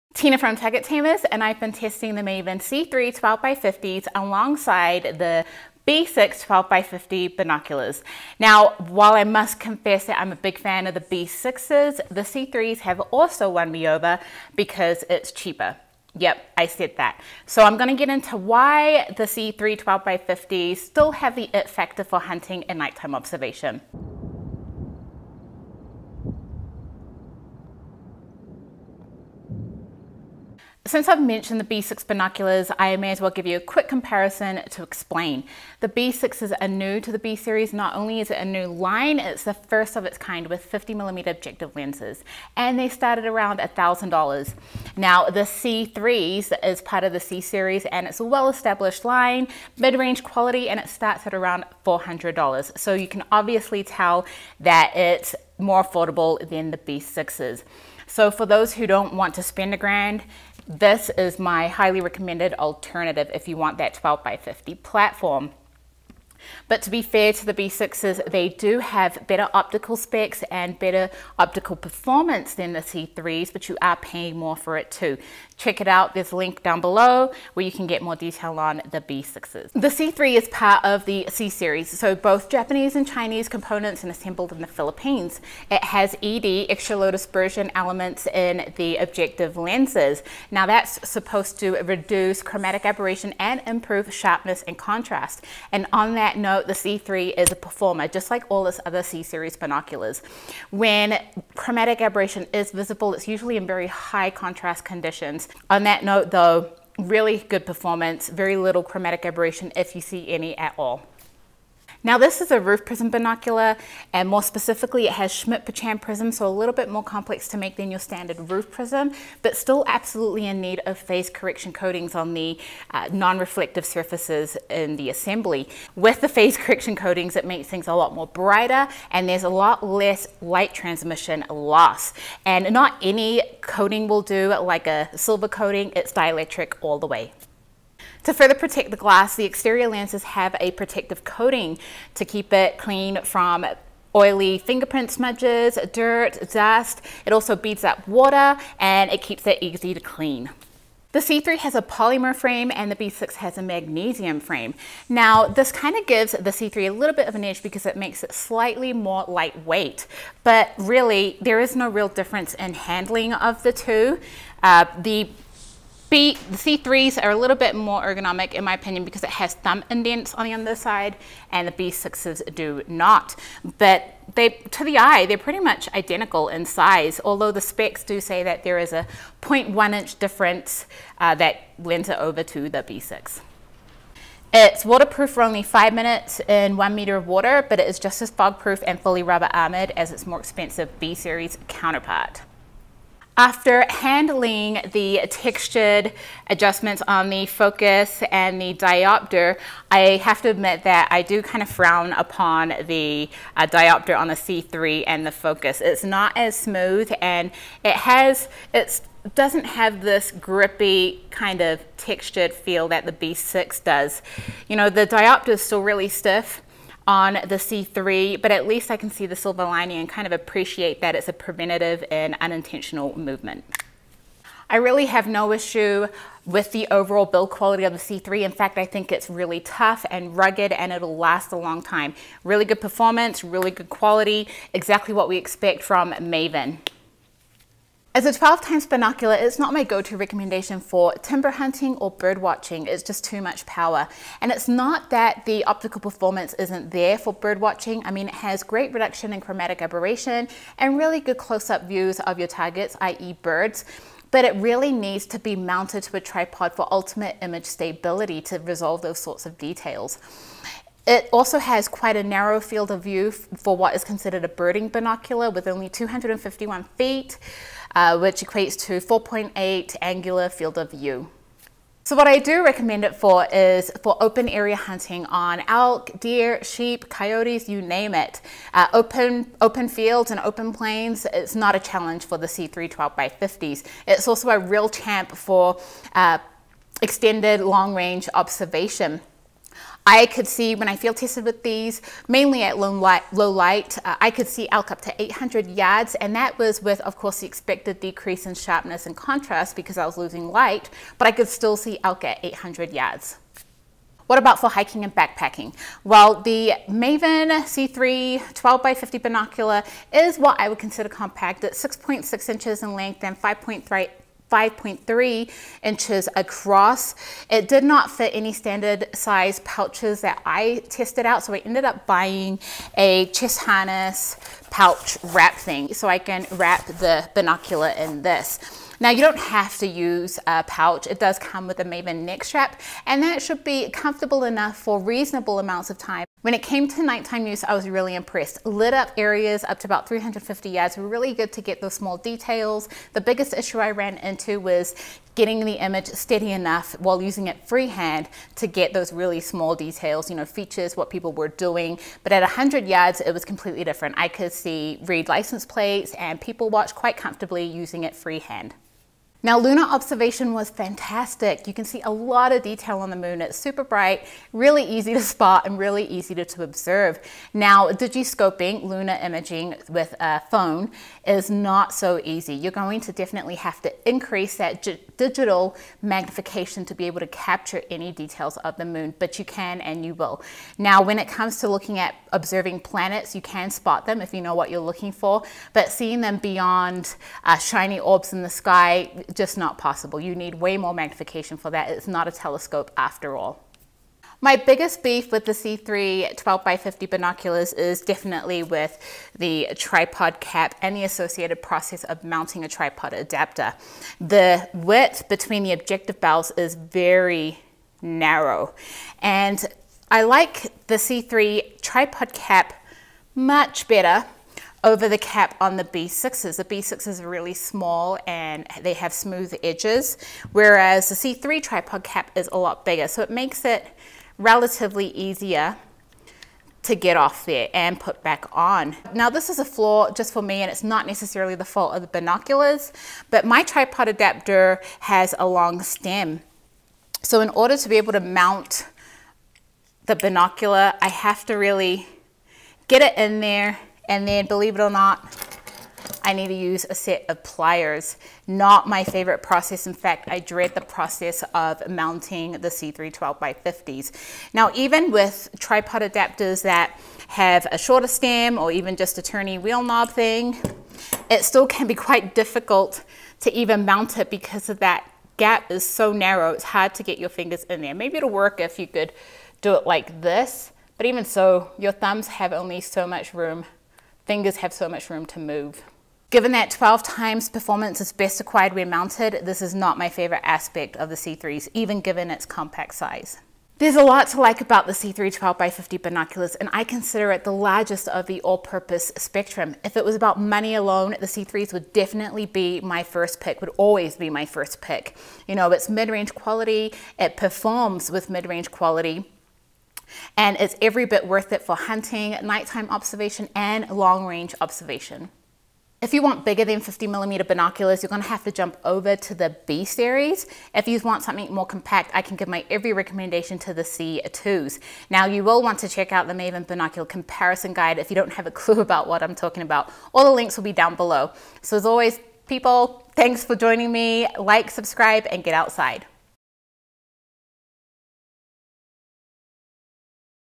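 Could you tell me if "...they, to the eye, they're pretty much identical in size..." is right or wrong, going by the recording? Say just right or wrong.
right.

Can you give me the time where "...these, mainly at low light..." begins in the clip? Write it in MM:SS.
04:51.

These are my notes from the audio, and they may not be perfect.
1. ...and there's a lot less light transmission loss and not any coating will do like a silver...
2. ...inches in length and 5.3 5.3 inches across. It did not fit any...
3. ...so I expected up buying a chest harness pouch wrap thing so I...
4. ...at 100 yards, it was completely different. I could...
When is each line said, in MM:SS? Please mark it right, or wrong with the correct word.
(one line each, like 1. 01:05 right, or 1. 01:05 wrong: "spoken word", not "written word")
1. 02:09 right
2. 05:12 right
3. 05:21 wrong: "ended", not "expected"
4. 05:52 right.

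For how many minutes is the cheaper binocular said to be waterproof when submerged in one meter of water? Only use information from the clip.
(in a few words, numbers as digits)
5.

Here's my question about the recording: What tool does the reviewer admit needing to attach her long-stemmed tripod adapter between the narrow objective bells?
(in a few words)
Pliers.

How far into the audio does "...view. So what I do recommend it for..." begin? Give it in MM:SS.
04:30.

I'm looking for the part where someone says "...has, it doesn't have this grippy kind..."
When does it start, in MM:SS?
03:27.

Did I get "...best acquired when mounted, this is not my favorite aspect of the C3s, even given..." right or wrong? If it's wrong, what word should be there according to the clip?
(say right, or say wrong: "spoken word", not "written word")
right.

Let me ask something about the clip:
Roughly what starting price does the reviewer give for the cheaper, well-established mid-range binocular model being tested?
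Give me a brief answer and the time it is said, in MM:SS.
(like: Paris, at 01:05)
$400, at 00:51.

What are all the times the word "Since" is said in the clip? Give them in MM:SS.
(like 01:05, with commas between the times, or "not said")
00:30.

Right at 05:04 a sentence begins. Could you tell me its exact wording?
What about for hiking and backpacking?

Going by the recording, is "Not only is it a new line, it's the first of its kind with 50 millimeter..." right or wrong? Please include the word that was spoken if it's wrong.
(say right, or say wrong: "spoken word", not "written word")
right.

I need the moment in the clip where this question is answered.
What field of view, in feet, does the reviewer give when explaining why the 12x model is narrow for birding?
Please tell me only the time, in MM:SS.
04:25.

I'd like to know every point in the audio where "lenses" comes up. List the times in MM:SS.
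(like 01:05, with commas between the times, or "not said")
00:41, 01:29, 02:19.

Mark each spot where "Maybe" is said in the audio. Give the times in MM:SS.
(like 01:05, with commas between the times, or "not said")
07:47.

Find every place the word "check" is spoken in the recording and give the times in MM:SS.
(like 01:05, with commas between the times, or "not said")
01:15, 08:35.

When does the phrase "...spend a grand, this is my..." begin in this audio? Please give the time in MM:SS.
00:59.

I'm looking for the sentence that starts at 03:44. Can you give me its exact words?
I really have no issue with the overall build quality of the C3.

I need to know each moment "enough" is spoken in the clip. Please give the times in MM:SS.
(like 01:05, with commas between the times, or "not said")
05:34, 05:46.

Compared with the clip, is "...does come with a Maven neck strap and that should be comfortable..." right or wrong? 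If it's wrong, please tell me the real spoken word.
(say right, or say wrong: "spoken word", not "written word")
right.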